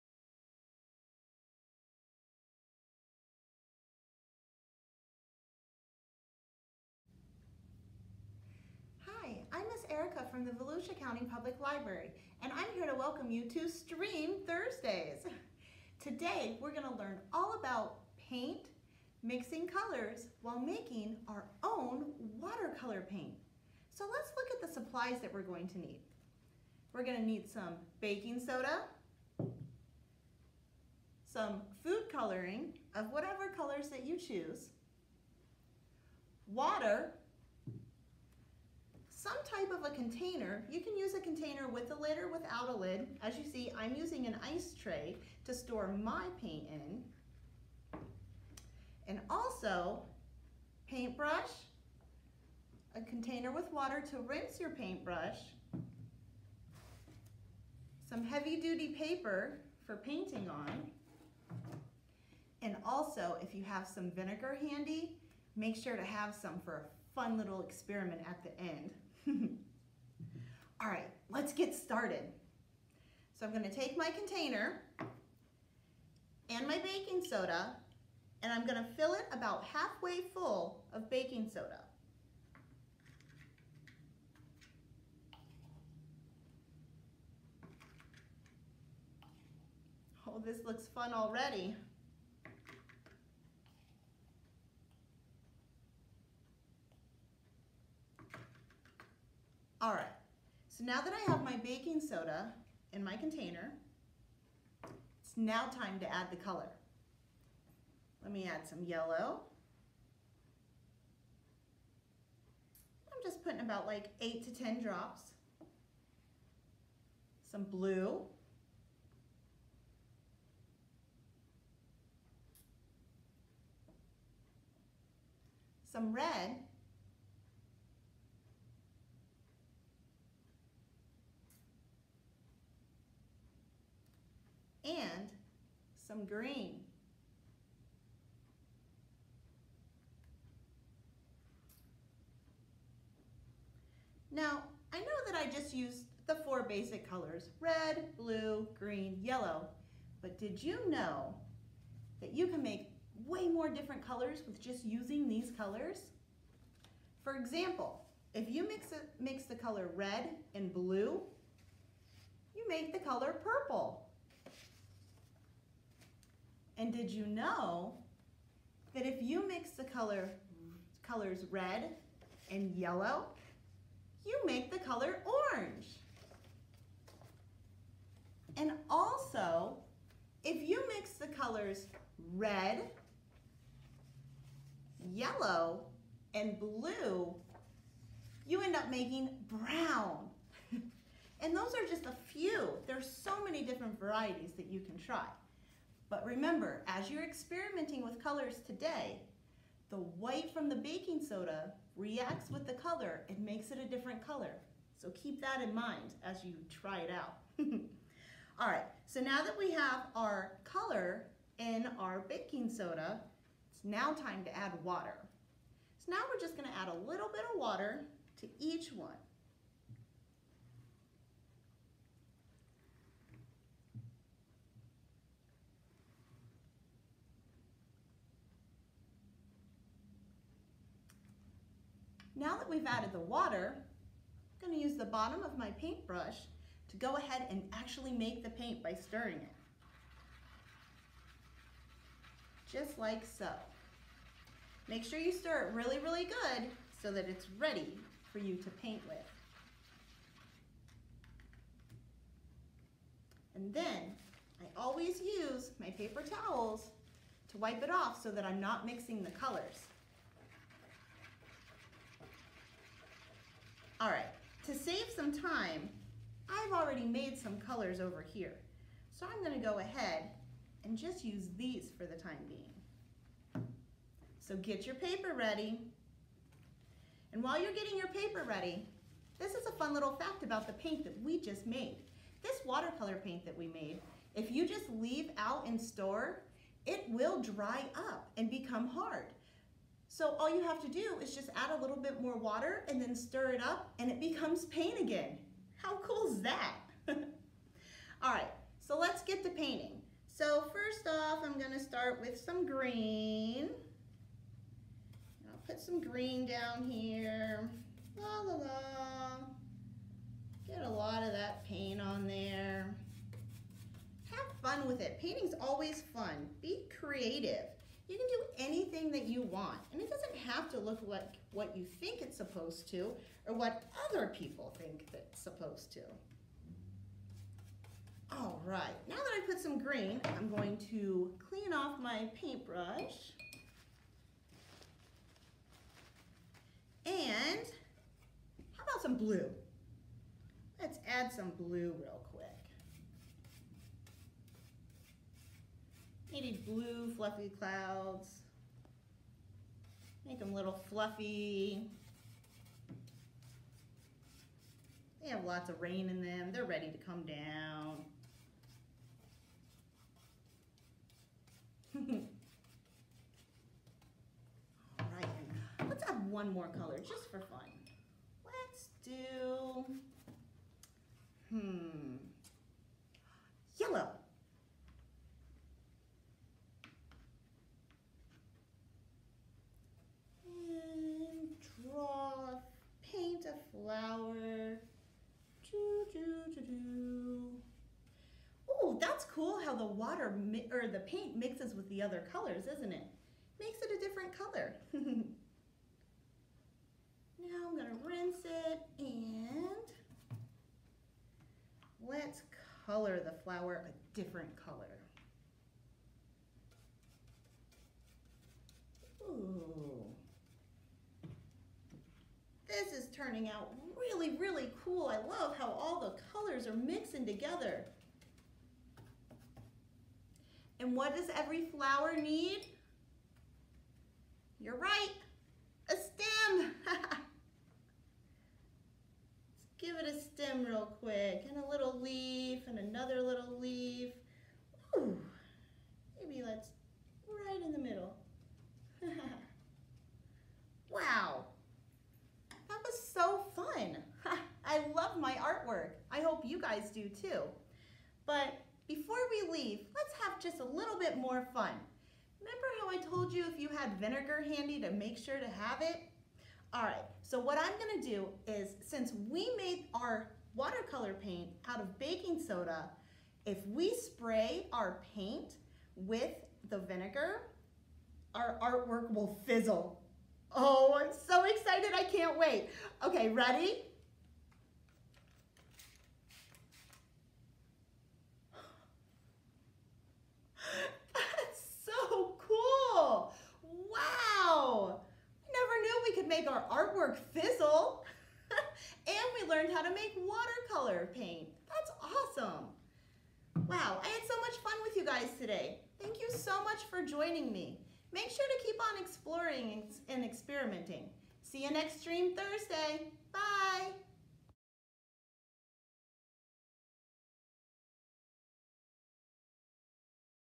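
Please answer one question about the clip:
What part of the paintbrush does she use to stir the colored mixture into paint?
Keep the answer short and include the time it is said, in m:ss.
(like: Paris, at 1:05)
the bottom, at 3:54.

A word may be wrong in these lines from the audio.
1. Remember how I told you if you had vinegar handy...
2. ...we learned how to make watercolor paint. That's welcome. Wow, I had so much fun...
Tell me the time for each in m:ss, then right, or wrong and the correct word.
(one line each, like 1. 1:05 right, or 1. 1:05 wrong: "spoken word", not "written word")
1. 7:32 right
2. 8:09 wrong: "awesome", not "welcome".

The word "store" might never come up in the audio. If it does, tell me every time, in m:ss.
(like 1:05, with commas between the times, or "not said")
0:45, 4:45.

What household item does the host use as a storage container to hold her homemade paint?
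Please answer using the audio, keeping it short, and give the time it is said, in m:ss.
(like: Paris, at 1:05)
ice tray, at 0:44.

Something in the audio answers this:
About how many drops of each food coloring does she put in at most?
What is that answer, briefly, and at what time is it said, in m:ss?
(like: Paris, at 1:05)
10, at 1:54.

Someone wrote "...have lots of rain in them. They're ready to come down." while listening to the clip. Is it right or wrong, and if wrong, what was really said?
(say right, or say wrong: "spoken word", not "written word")
right.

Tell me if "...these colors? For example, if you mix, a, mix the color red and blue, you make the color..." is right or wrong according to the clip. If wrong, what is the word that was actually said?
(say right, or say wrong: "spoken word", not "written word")
right.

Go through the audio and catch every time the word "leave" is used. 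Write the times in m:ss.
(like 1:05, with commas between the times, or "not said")
4:44, 7:29.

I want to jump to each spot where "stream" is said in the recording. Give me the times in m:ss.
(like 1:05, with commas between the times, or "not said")
0:13, 8:22.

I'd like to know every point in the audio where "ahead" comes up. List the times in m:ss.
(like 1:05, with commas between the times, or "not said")
3:57, 4:29.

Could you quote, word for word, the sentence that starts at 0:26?
We're gonna need some baking soda, some food coloring of whatever colors that you choose, water, some type of a container.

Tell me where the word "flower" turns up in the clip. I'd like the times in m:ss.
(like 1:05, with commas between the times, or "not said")
6:23, 6:43, 7:01.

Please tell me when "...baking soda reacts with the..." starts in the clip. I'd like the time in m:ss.
3:20.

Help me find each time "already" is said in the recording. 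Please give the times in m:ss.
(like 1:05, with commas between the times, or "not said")
1:31, 4:26.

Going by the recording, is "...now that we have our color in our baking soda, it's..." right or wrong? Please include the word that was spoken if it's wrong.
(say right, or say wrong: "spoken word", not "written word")
right.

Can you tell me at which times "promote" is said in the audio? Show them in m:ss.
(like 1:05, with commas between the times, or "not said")
not said.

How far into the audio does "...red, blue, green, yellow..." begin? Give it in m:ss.
2:27.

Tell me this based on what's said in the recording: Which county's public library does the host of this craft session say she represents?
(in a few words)
Volusia County.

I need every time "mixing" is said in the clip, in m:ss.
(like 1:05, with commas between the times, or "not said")
0:19, 4:18, 6:56.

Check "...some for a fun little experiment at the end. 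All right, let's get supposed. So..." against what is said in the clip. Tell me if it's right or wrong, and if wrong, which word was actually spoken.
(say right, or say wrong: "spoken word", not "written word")
wrong: "started", not "supposed".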